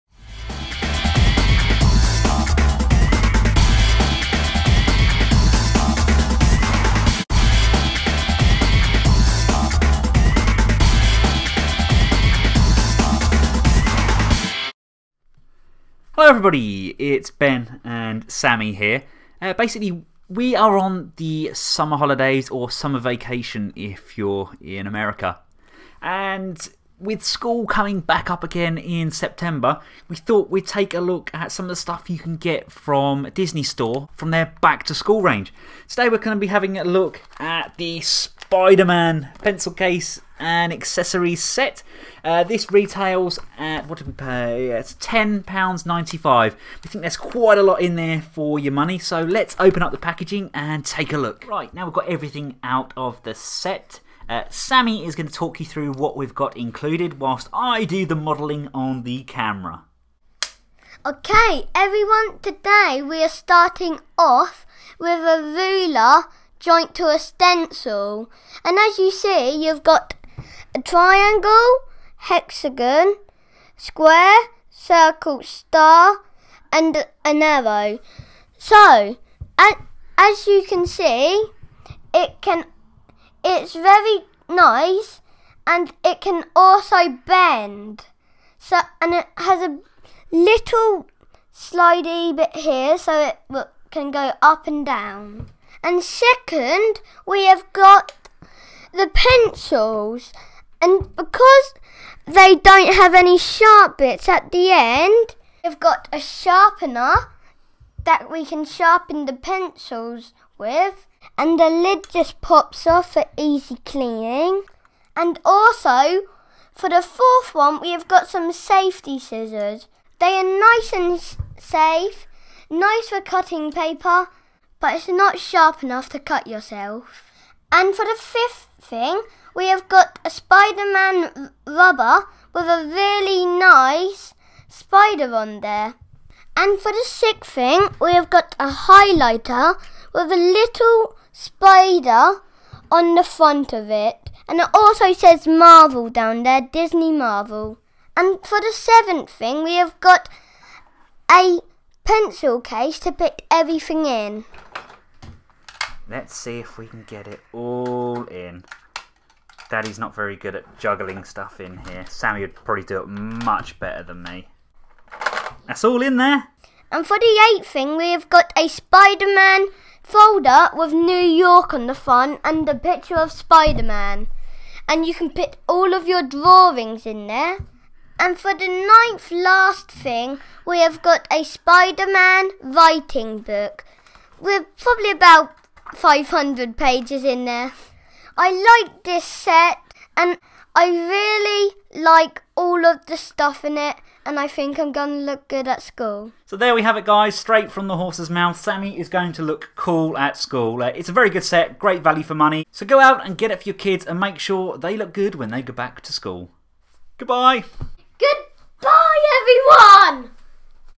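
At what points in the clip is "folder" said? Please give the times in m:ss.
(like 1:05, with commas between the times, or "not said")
2:50.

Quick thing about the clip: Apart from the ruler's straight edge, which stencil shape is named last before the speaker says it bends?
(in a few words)
an arrow.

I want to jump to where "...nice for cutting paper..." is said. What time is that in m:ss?
2:02.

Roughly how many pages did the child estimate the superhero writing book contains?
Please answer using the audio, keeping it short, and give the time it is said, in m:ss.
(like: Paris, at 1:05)
500, at 3:05.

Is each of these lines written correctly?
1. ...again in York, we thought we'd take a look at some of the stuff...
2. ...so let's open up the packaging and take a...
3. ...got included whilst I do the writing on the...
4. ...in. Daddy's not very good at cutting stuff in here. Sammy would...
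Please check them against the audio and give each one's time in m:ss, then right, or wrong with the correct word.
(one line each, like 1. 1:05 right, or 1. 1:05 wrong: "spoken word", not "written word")
1. 0:28 wrong: "September", not "York"
2. 0:48 right
3. 0:56 wrong: "modelling", not "writing"
4. 2:38 wrong: "juggling", not "cutting".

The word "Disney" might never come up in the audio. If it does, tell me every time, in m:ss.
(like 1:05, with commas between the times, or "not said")
0:33, 2:26.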